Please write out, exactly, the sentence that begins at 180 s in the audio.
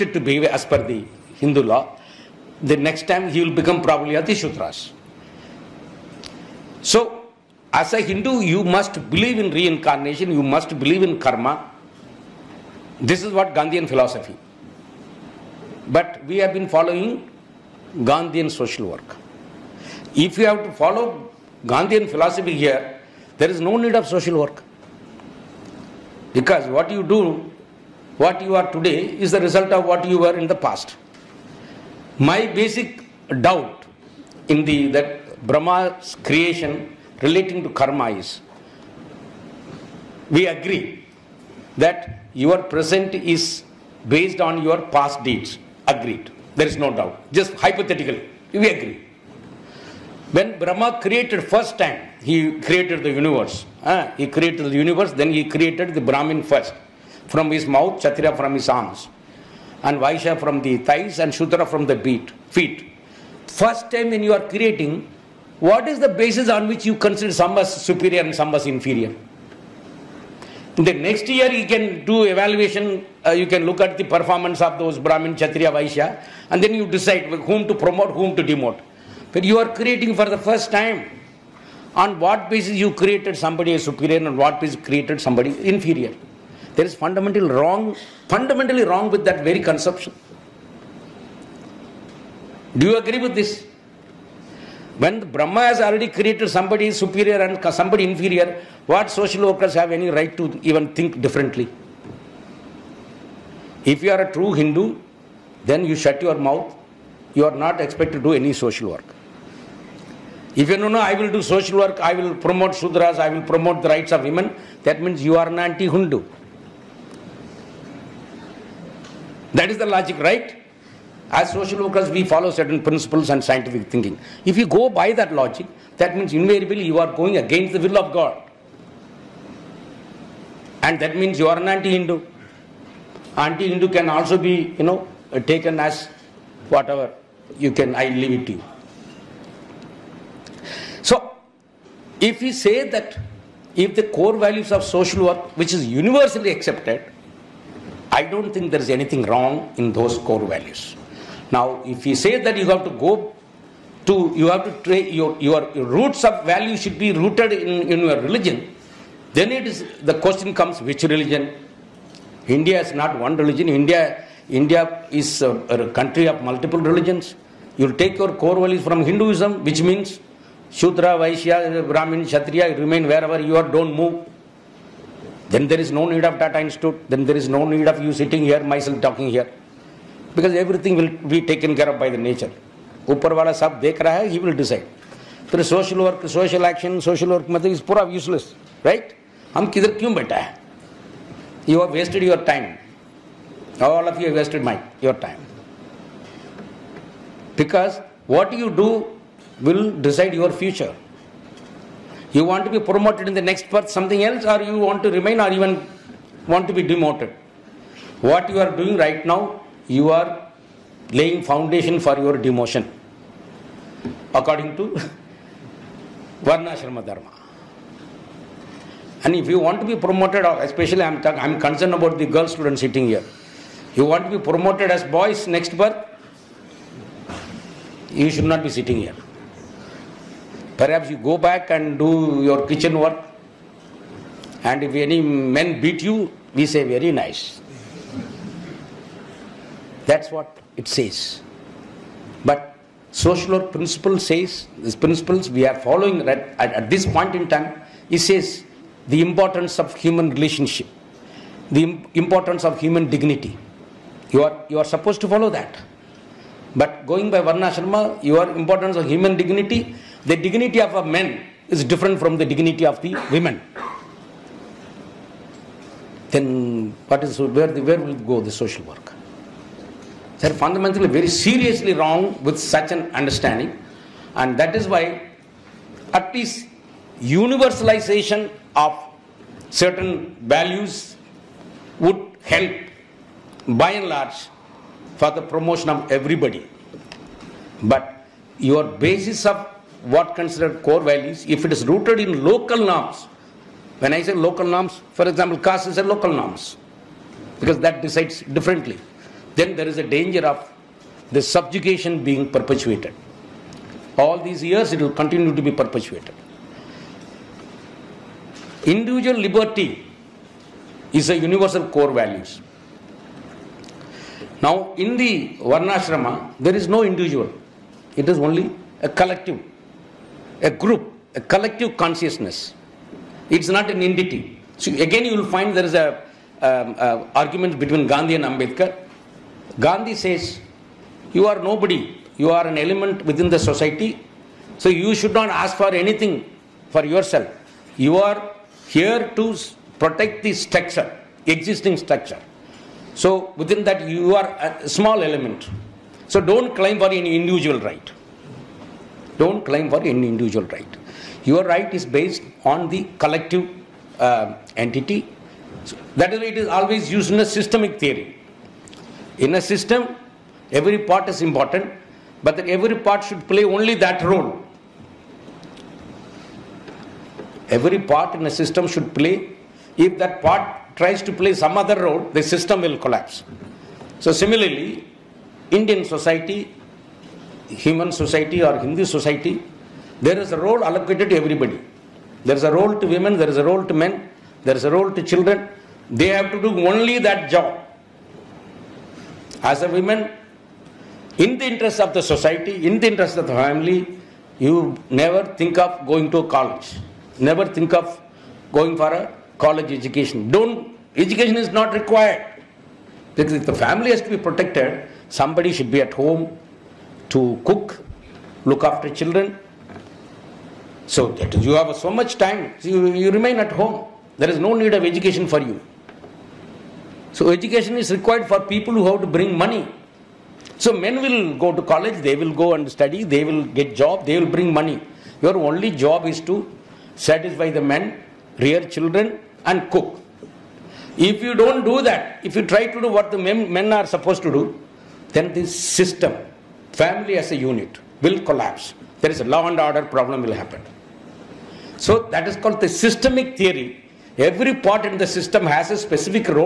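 Because everything will be taken care of by the nature.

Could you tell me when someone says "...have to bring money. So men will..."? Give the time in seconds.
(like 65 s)
419 s.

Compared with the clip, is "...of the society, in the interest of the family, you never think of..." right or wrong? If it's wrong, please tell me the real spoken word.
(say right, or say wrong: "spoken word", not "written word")
right.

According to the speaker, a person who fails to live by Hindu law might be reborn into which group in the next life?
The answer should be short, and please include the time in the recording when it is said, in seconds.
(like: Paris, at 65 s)
Ati Shudras, at 4 s.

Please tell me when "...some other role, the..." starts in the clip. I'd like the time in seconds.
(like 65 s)
371 s.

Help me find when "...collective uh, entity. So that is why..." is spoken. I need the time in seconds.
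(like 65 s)
353 s.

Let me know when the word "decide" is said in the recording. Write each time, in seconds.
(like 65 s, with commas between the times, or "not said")
76 s, 184 s, 199 s, 298 s.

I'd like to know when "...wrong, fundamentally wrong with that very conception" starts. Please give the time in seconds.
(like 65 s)
87 s.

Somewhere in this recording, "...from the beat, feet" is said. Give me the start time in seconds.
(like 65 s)
61 s.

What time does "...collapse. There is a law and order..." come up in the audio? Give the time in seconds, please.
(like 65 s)
438 s.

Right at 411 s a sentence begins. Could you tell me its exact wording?
So that you have so much time, so you, you remain at home.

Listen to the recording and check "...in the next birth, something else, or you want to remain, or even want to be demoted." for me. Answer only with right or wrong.
right.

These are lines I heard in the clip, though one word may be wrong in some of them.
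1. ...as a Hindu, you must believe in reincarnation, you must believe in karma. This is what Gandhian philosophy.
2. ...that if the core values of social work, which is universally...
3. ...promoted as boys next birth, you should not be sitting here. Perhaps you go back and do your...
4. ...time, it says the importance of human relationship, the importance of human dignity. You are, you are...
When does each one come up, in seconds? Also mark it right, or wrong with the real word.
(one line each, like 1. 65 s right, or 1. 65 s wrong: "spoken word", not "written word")
1. 7 s right
2. 142 s right
3. 224 s right
4. 247 s right.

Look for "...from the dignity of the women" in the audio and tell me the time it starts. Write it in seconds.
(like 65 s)
262 s.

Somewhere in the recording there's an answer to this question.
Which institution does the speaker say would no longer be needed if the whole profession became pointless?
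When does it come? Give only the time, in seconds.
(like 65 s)
176 s.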